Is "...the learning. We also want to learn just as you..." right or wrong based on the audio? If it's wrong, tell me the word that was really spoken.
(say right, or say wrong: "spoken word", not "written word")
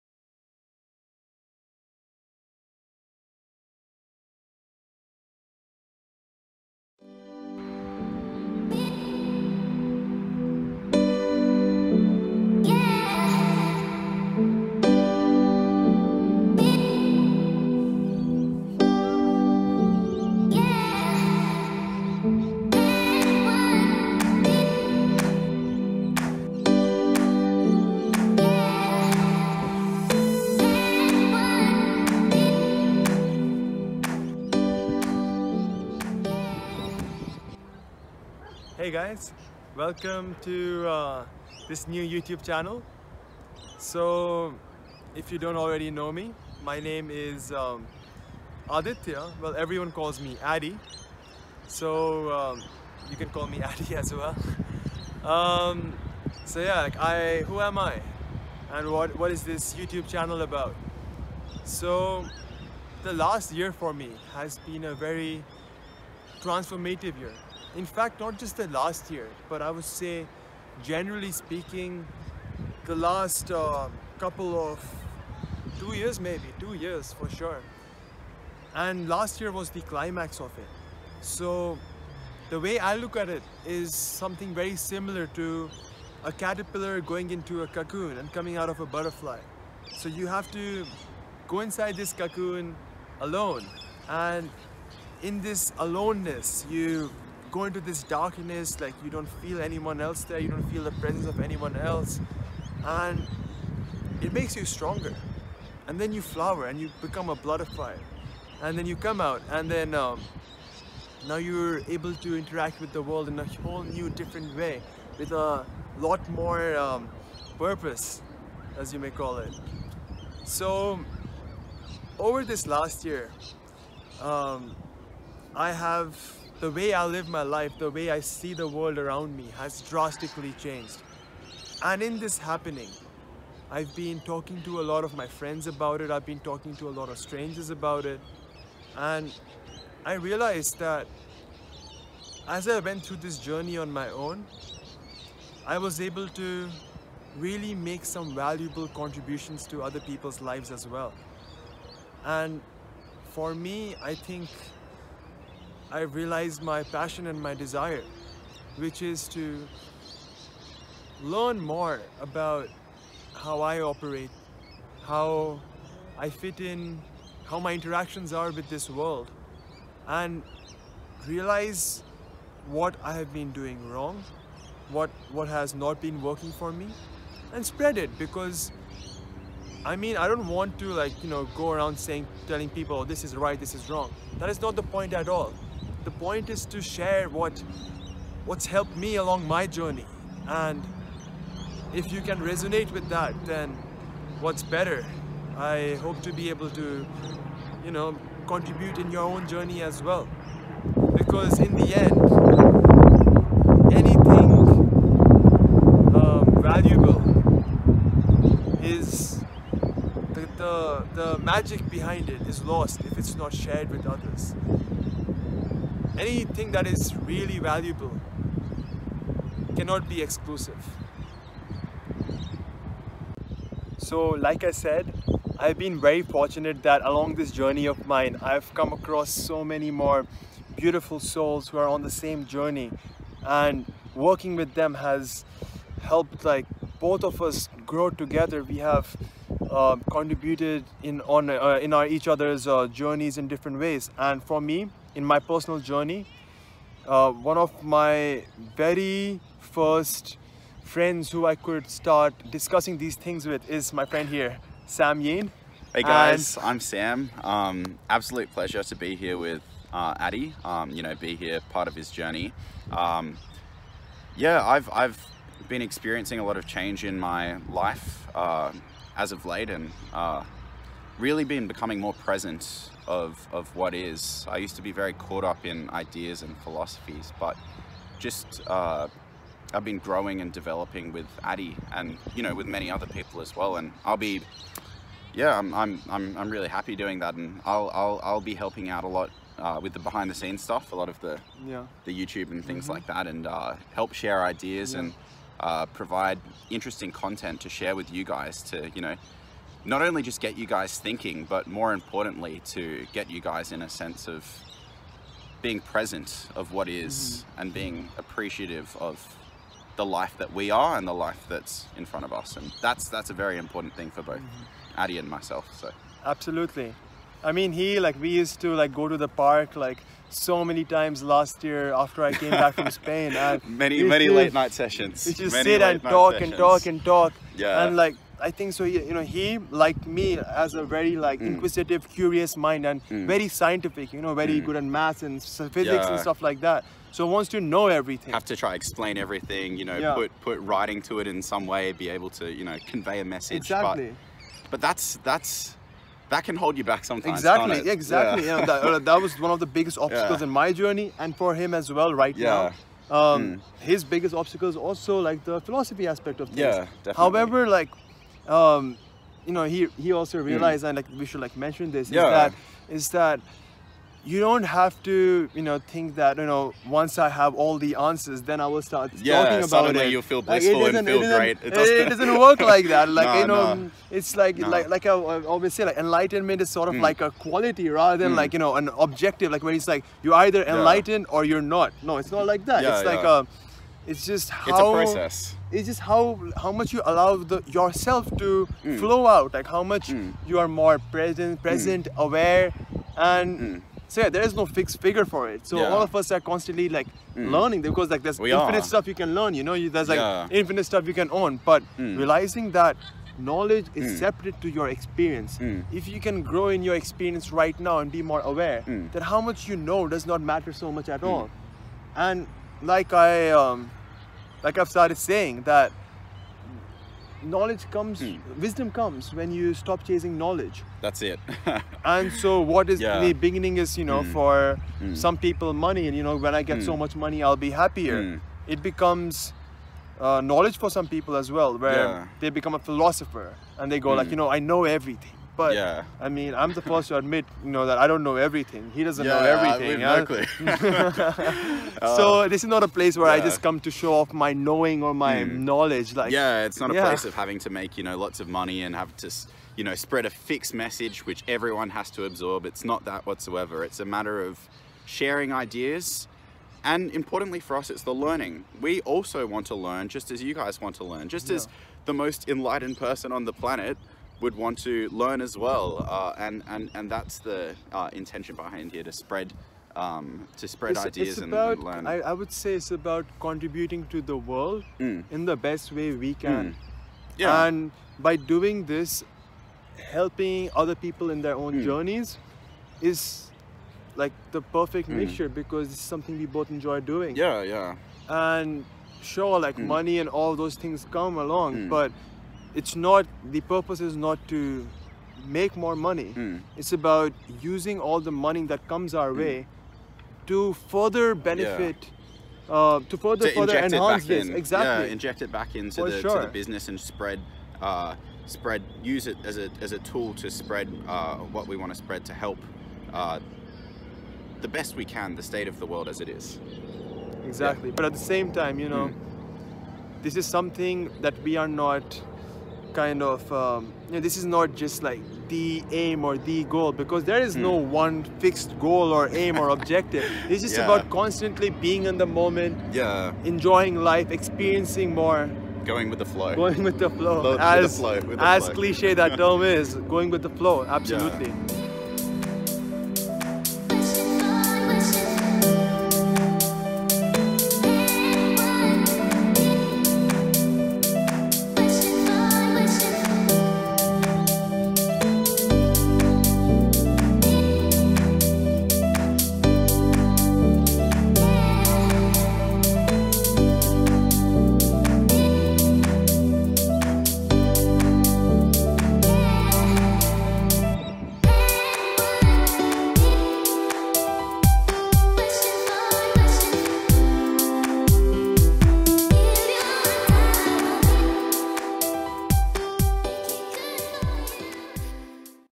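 right.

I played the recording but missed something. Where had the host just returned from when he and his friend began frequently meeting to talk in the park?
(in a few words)
Spain.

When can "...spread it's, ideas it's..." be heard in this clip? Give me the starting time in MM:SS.
07:50.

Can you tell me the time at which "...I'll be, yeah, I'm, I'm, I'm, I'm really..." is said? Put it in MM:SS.
04:44.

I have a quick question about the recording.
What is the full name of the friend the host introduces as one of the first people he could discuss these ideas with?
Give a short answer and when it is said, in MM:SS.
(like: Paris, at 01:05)
Sam Yin, at 04:14.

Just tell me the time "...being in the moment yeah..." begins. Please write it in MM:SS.
08:51.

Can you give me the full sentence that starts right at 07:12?
they become a philosopher and they go like you know i know everything but yeah.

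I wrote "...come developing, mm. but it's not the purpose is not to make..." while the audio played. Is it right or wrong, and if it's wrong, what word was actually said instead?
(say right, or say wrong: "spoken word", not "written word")
wrong: "along", not "developing".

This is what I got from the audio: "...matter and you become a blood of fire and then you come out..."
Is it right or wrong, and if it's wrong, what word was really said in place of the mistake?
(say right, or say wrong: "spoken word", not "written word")
wrong: "flower", not "matter".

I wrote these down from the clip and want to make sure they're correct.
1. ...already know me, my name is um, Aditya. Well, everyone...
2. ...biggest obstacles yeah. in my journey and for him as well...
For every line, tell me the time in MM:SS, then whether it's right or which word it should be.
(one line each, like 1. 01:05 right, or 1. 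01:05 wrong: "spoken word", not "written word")
1. 00:45 right
2. 05:49 right.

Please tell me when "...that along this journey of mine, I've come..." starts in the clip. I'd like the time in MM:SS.
03:46.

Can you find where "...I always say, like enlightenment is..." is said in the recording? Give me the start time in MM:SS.
06:15.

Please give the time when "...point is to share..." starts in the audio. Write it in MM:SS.
03:06.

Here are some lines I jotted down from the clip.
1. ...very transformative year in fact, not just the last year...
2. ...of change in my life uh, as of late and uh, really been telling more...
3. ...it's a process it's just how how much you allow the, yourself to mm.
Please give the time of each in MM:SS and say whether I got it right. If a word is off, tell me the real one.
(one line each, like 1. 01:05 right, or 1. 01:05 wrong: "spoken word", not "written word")
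1. 01:04 right
2. 04:26 wrong: "becoming", not "telling"
3. 06:24 right.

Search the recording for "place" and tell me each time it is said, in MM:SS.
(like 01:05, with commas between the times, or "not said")
07:22, 07:26.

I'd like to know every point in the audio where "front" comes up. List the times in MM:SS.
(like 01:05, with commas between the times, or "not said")
05:12.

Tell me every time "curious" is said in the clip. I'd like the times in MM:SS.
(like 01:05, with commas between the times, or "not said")
05:32.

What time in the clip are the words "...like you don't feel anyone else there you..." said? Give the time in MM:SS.
01:38.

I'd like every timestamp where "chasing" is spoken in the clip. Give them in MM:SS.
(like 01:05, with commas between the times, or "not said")
07:00.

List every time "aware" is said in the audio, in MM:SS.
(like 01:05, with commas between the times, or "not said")
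06:32, 06:48.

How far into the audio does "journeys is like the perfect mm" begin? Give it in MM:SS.
08:01.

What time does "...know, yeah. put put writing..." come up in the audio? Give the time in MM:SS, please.
05:39.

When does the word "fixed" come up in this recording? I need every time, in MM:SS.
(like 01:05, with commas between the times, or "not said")
06:34, 07:30, 08:48.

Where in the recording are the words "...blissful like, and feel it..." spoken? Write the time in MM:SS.
06:10.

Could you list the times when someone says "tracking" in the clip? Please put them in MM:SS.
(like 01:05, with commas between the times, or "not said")
not said.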